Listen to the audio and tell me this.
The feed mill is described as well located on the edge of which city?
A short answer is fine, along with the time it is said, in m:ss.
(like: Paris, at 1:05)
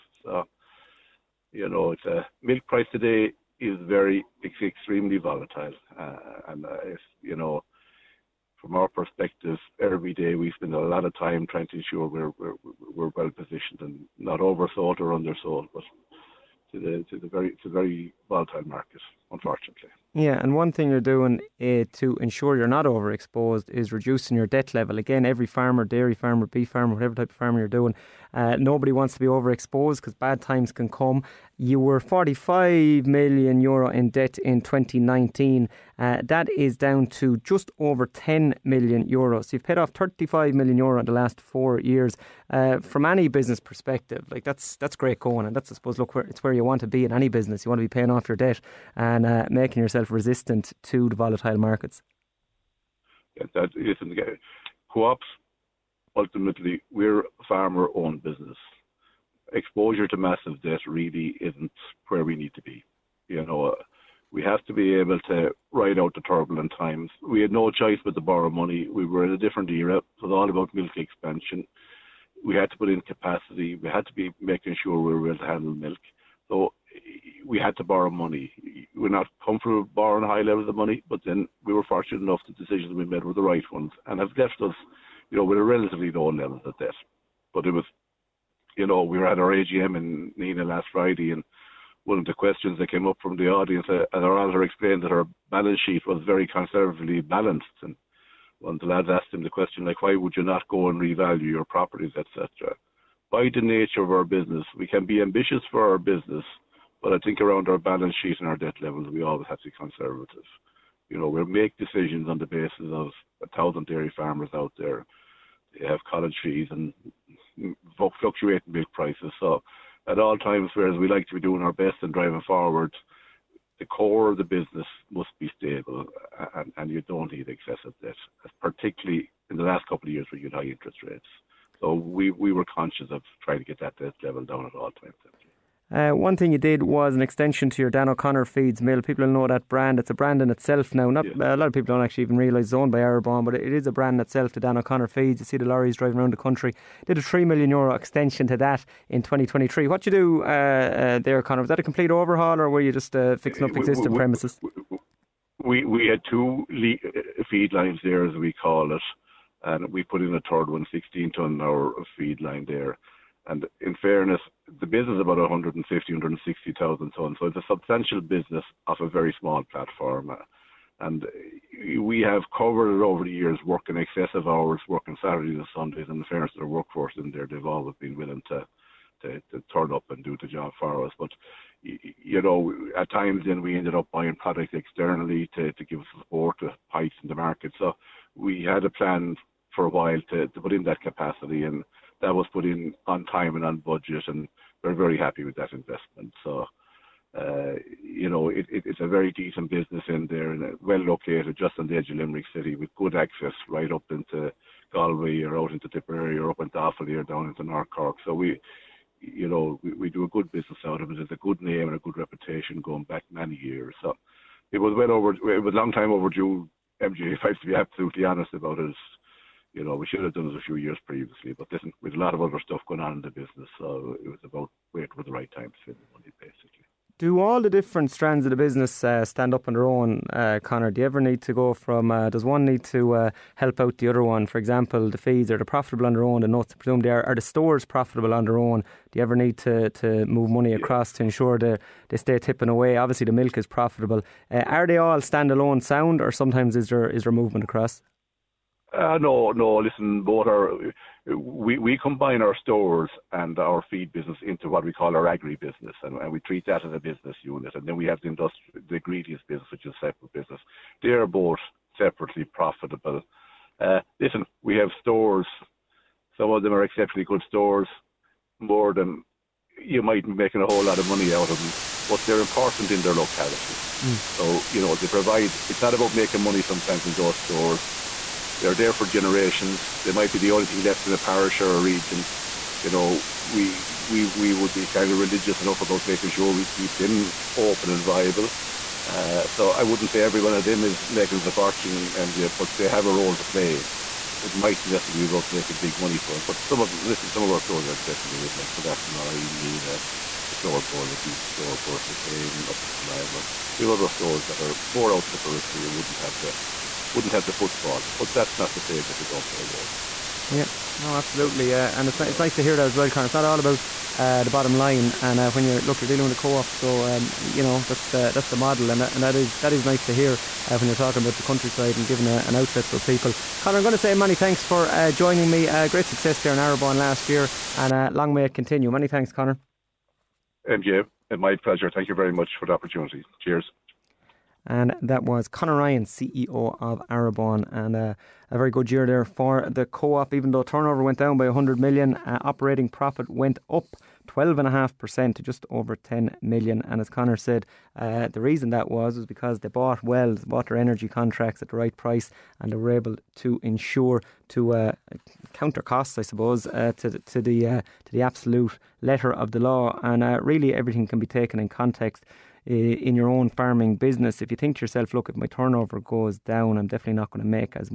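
Limerick, at 3:22.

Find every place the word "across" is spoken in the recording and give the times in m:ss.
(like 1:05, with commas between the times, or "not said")
4:00, 4:07.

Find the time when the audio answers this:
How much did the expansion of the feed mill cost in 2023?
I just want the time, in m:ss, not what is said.
2:27.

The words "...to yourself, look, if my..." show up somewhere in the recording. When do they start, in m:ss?
6:04.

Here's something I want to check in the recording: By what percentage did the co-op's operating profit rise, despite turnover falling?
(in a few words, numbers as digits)
12.5%.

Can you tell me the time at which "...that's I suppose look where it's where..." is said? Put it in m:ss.
0:45.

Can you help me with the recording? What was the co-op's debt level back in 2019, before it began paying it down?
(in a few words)
45 million euro.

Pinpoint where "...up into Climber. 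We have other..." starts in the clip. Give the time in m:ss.
5:02.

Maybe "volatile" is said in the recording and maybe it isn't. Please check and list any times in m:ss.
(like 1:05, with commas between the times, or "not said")
0:05, 0:18, 0:51.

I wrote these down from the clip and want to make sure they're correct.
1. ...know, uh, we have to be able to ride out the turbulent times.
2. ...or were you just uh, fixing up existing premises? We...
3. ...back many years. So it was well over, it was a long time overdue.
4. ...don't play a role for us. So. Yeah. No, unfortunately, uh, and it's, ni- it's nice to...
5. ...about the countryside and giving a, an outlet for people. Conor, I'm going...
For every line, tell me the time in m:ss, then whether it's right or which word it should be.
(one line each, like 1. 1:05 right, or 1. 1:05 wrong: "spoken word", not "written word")
1. 1:03 right
2. 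2:32 right
3. 3:33 right
4. 5:09 wrong: "absolutely", not "unfortunately"
5. 5:21 right.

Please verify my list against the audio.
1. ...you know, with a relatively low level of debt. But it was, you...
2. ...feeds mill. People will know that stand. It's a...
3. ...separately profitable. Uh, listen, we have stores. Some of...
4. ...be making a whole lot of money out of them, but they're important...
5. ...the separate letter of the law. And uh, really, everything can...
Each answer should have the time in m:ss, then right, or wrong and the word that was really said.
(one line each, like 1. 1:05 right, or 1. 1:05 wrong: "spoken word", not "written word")
1. 1:25 right
2. 2:18 wrong: "brand", not "stand"
3. 4:21 right
4. 4:30 right
5. 5:58 wrong: "absolute", not "separate".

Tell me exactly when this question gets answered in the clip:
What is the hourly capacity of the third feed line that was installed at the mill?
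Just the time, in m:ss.
2:40.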